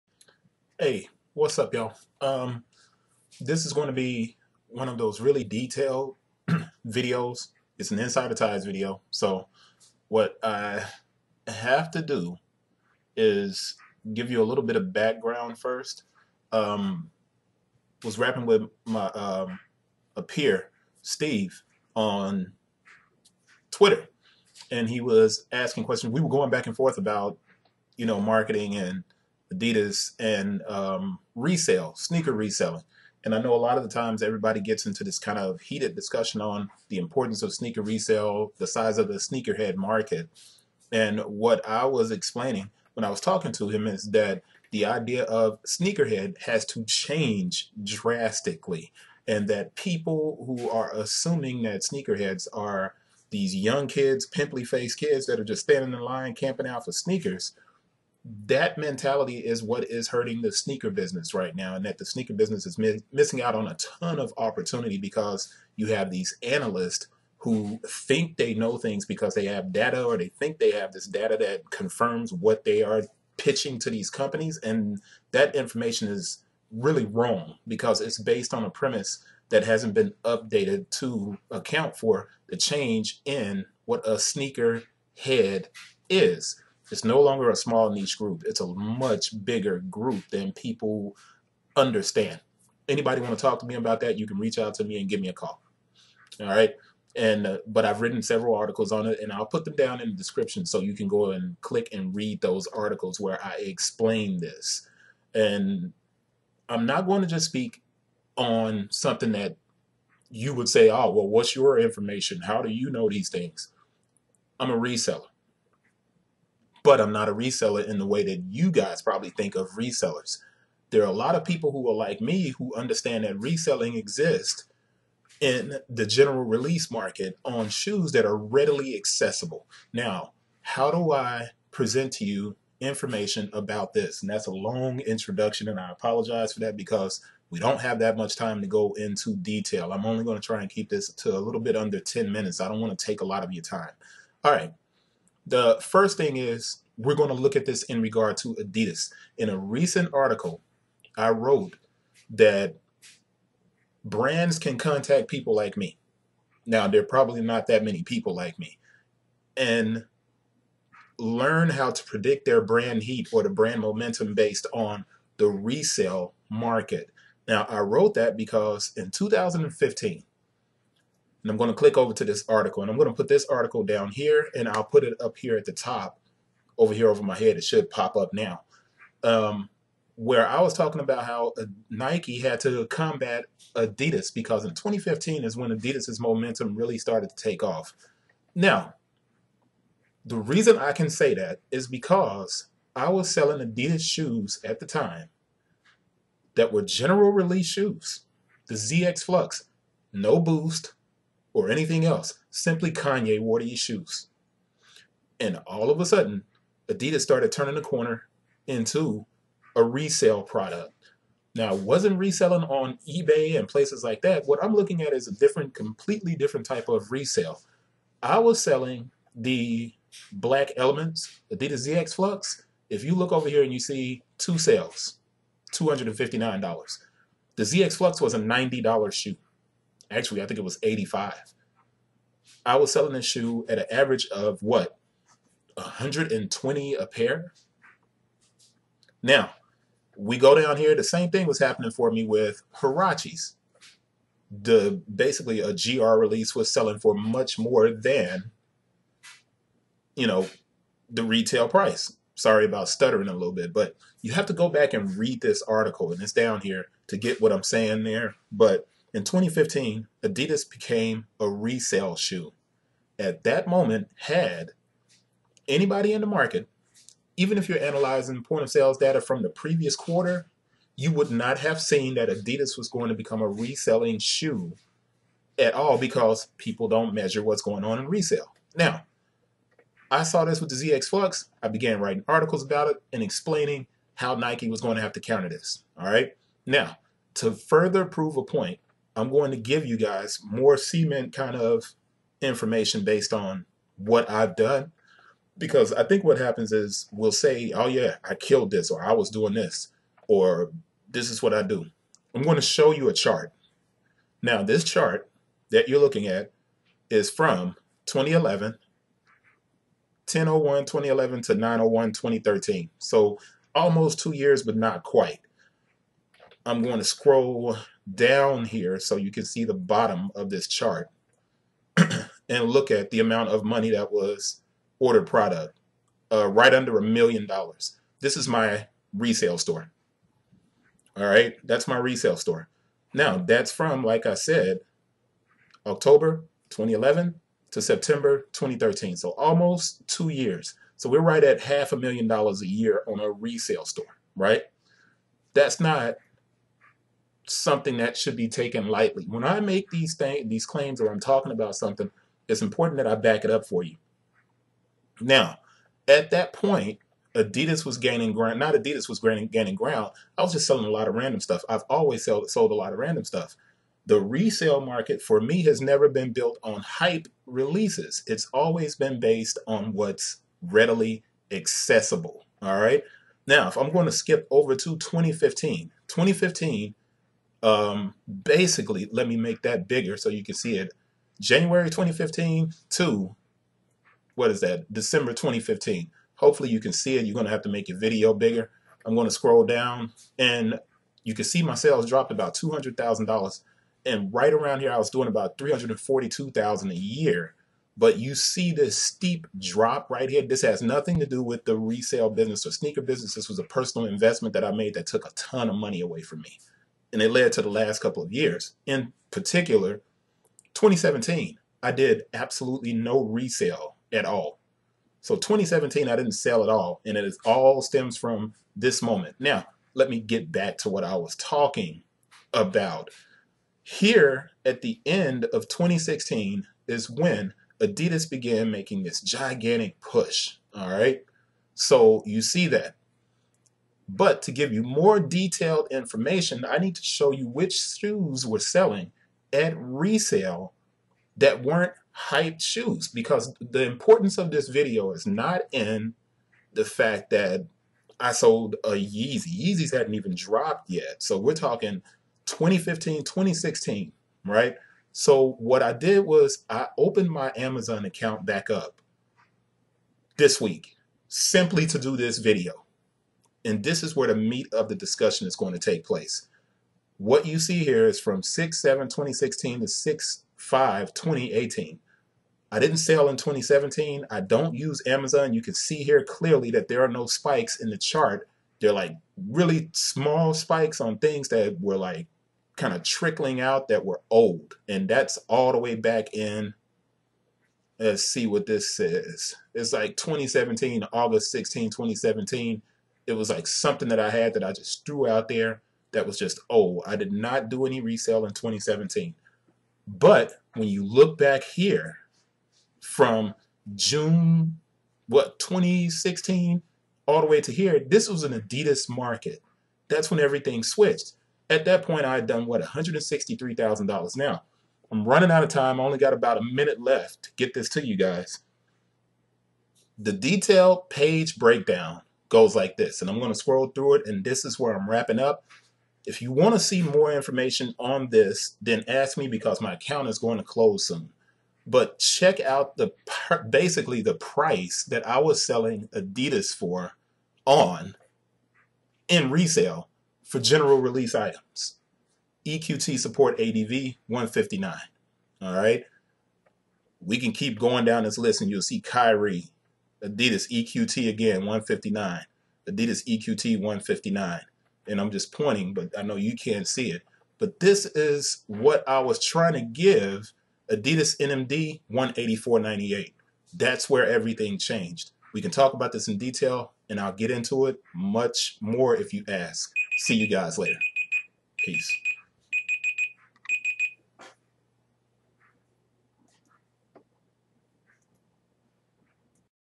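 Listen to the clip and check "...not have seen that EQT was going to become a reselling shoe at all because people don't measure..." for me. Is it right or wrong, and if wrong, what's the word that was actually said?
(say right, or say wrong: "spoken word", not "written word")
wrong: "Adidas", not "EQT".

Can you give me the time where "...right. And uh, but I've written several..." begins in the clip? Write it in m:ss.
1:36.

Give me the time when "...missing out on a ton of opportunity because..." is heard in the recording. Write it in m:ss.
1:03.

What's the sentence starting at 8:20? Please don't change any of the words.
But when you look back here from June, what, 2016 all the way to here, this was an Adidas market.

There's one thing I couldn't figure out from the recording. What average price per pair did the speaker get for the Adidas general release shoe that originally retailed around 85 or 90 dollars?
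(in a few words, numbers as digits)
$120.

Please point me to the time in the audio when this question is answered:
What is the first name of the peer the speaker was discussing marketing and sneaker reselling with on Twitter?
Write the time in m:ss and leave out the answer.
0:21.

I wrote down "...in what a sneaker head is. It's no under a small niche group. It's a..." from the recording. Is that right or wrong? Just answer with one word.
wrong.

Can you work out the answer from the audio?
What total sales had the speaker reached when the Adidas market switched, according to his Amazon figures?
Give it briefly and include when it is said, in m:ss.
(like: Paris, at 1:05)
$163,000, at 8:32.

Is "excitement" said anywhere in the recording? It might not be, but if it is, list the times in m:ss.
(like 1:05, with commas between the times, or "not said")
not said.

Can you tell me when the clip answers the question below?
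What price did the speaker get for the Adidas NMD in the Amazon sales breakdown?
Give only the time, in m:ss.
9:22.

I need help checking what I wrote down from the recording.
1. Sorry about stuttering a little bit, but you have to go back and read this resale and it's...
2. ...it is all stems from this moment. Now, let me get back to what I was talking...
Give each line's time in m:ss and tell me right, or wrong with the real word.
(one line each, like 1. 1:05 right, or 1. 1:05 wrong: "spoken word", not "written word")
1. 4:12 wrong: "article", not "resale"
2. 6:57 right.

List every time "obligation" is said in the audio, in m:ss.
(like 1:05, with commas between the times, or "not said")
not said.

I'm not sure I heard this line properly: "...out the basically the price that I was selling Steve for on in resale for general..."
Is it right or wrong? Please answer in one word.
wrong.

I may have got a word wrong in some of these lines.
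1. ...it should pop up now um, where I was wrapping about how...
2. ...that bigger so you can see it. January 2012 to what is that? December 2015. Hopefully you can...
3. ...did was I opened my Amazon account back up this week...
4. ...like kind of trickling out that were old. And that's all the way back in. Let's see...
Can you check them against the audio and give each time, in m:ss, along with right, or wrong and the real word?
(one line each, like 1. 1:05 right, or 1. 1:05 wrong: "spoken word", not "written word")
1. 2:57 wrong: "talking", not "wrapping"
2. 6:19 wrong: "2015", not "2012"
3. 7:35 right
4. 8:01 right.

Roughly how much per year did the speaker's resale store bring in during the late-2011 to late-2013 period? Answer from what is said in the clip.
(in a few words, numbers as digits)
half a million dollars.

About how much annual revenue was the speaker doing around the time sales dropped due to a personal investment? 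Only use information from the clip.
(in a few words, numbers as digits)
$342,000.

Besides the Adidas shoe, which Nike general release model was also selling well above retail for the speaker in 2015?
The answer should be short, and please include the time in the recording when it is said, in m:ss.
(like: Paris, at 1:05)
Huaraches, at 4:02.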